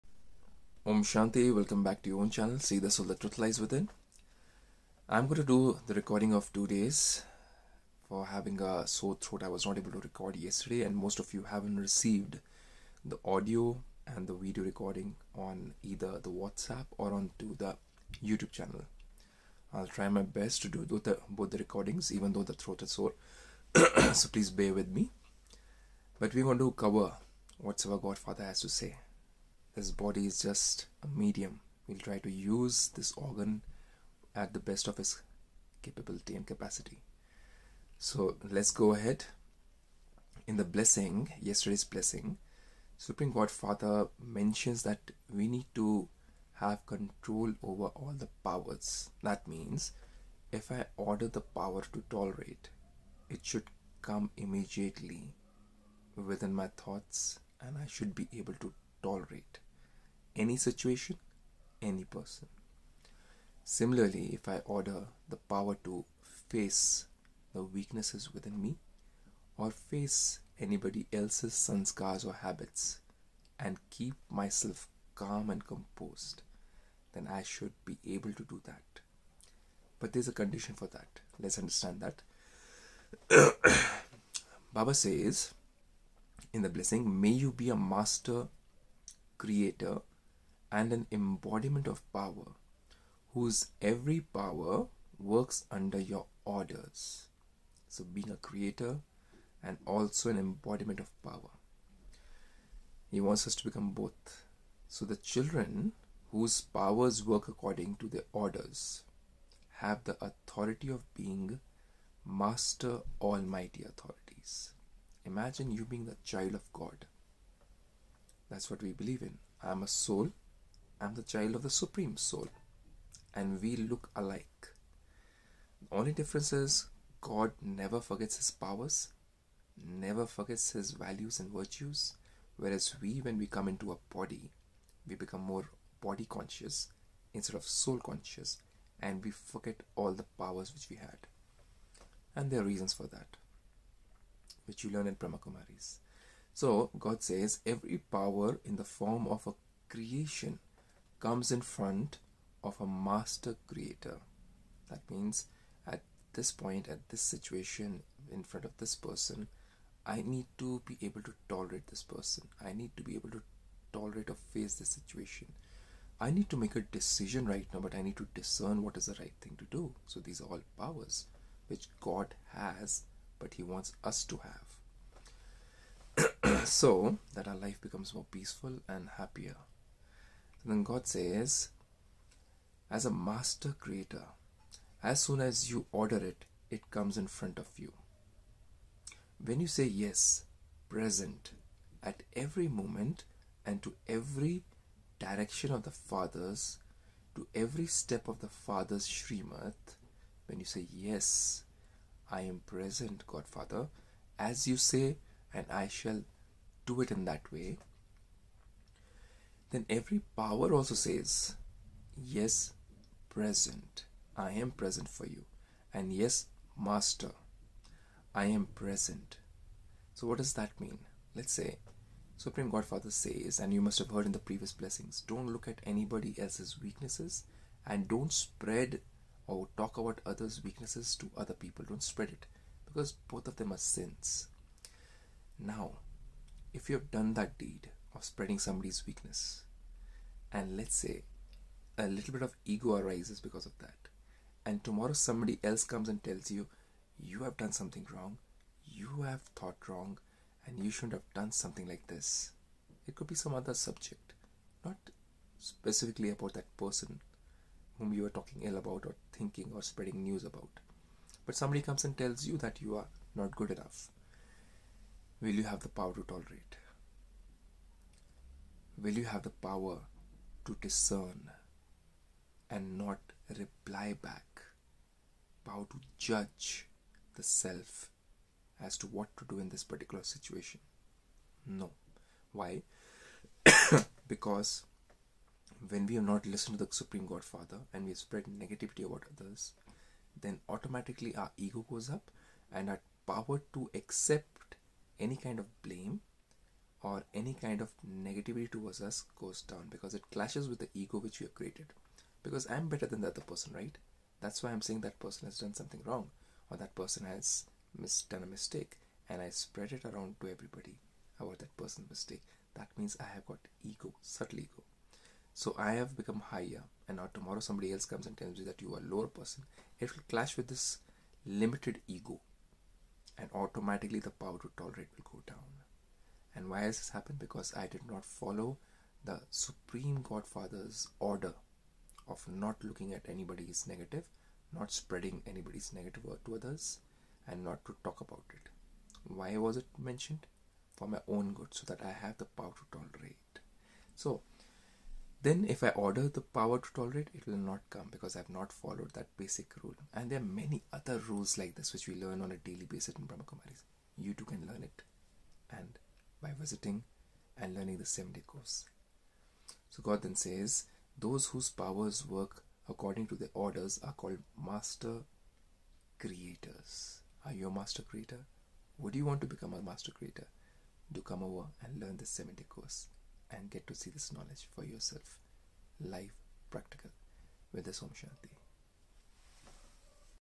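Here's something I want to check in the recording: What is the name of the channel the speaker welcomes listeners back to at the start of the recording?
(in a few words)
See the Soul That Truth Lies Within.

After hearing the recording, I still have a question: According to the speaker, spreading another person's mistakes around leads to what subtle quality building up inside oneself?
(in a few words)
Subtle ego.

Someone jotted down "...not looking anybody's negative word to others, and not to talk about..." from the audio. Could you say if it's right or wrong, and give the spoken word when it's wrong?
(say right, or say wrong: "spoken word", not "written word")
wrong: "spreading", not "looking".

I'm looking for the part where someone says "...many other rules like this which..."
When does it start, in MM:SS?
05:50.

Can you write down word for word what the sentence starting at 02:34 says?
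That means at this point, at this situation, in front of this person, I need to be able to tolerate this person.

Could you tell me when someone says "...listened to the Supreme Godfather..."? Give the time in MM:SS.
04:46.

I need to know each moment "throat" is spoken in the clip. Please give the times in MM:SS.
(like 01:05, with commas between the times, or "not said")
00:09, 00:22.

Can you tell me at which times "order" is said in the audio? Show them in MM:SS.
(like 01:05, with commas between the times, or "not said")
00:50, 01:04, 01:36, 01:48, 03:05, 05:31, 05:45, 06:03.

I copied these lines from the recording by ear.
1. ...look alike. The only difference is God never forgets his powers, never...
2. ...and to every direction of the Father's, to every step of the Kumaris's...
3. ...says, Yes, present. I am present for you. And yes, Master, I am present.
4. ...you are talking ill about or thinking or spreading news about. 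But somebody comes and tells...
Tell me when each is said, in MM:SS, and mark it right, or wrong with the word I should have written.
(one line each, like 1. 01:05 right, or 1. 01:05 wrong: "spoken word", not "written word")
1. 02:03 right
2. 03:13 wrong: "Father", not "Kumaris"
3. 03:30 right
4. 04:18 right.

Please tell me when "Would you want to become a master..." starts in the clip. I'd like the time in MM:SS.
06:08.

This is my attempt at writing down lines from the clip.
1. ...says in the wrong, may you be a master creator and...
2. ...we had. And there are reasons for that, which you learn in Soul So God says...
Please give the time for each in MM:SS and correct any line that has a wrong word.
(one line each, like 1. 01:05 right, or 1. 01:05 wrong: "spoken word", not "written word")
1. 01:24 wrong: "blessing", not "wrong"
2. 02:20 wrong: "Brahma", not "Soul".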